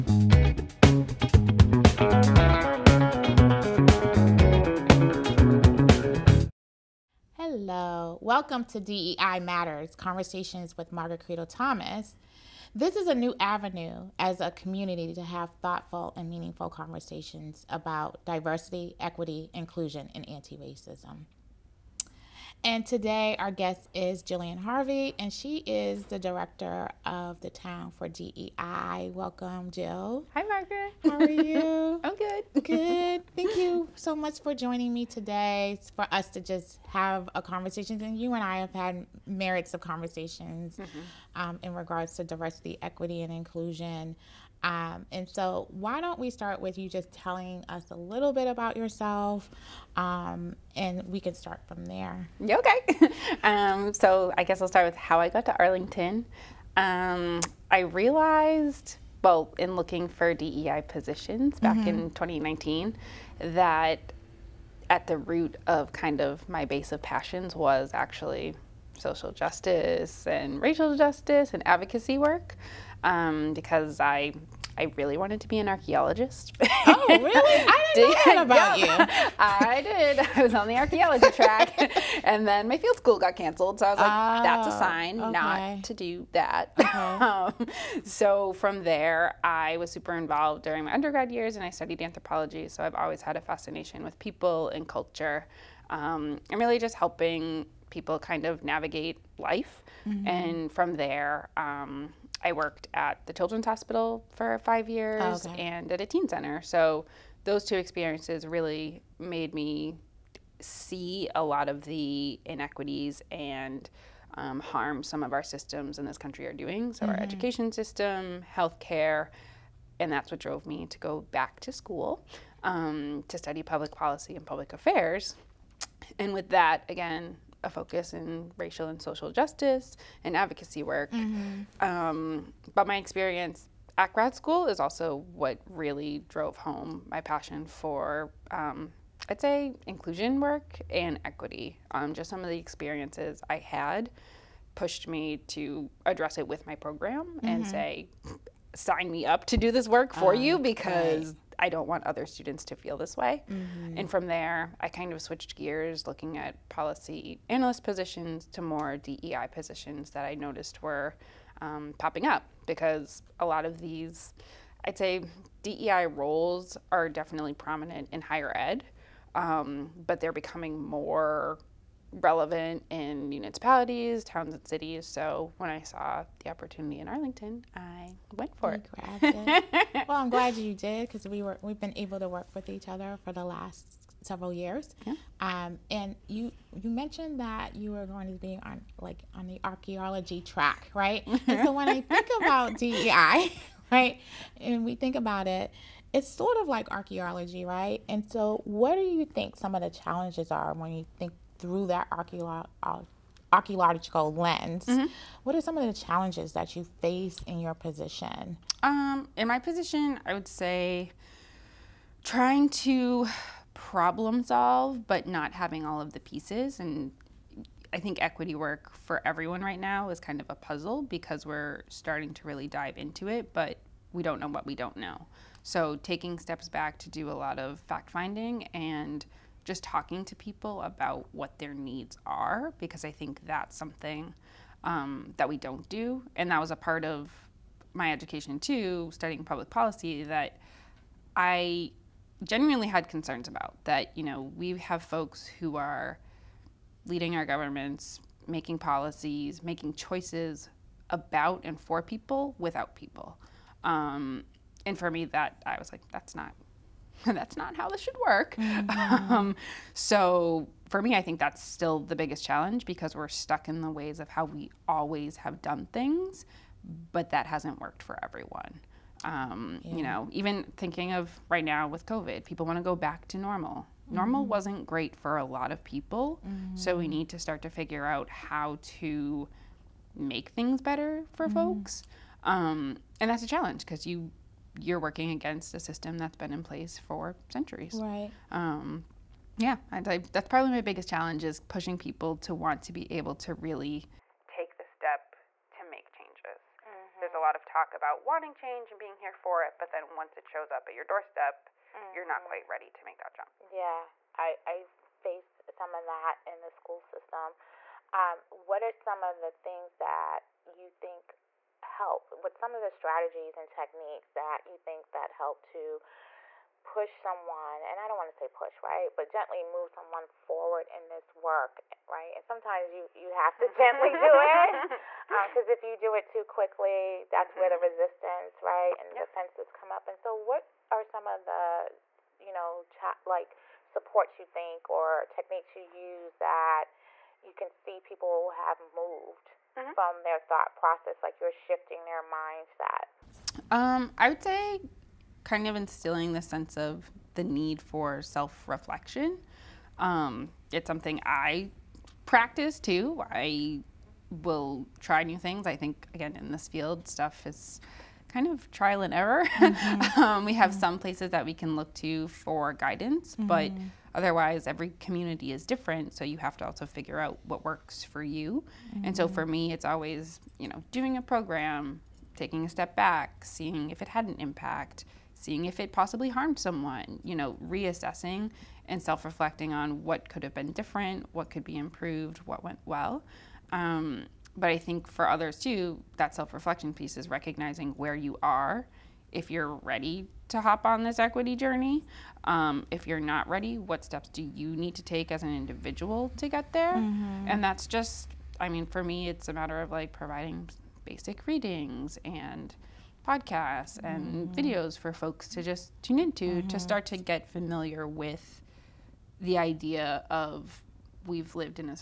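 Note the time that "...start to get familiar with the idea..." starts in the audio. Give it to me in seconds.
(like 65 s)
406 s.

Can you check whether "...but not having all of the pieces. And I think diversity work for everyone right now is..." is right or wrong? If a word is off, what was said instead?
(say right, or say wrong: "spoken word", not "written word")
wrong: "equity", not "diversity".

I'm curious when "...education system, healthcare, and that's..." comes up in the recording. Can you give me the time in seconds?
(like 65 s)
117 s.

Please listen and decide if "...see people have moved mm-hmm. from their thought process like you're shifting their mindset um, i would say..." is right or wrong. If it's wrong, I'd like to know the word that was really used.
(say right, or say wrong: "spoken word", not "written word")
right.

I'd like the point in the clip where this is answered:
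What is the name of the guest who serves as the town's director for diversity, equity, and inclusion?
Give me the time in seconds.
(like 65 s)
24 s.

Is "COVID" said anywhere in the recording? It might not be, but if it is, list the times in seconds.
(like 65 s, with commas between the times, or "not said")
272 s.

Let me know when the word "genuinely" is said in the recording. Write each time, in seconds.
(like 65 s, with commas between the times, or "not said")
242 s.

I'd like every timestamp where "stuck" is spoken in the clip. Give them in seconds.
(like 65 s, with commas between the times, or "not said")
263 s.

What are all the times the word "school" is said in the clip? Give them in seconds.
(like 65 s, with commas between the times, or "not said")
82 s, 121 s, 134 s, 306 s.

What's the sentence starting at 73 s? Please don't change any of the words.
Um, because I I really wanted to be an archaeologist.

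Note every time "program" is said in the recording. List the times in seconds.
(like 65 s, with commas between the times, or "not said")
146 s, 371 s.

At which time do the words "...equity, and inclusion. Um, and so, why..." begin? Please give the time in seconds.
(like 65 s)
42 s.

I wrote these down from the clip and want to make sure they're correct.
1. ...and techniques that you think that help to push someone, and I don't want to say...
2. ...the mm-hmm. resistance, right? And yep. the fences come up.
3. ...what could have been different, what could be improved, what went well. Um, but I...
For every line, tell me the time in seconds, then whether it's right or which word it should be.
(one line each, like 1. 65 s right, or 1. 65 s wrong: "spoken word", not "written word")
1. 313 s right
2. 327 s right
3. 380 s right.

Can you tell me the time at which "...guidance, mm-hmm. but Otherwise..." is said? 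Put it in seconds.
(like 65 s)
362 s.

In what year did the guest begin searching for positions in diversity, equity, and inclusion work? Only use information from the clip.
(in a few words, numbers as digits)
2019.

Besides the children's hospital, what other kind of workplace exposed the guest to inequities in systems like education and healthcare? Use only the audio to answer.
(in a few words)
teen center.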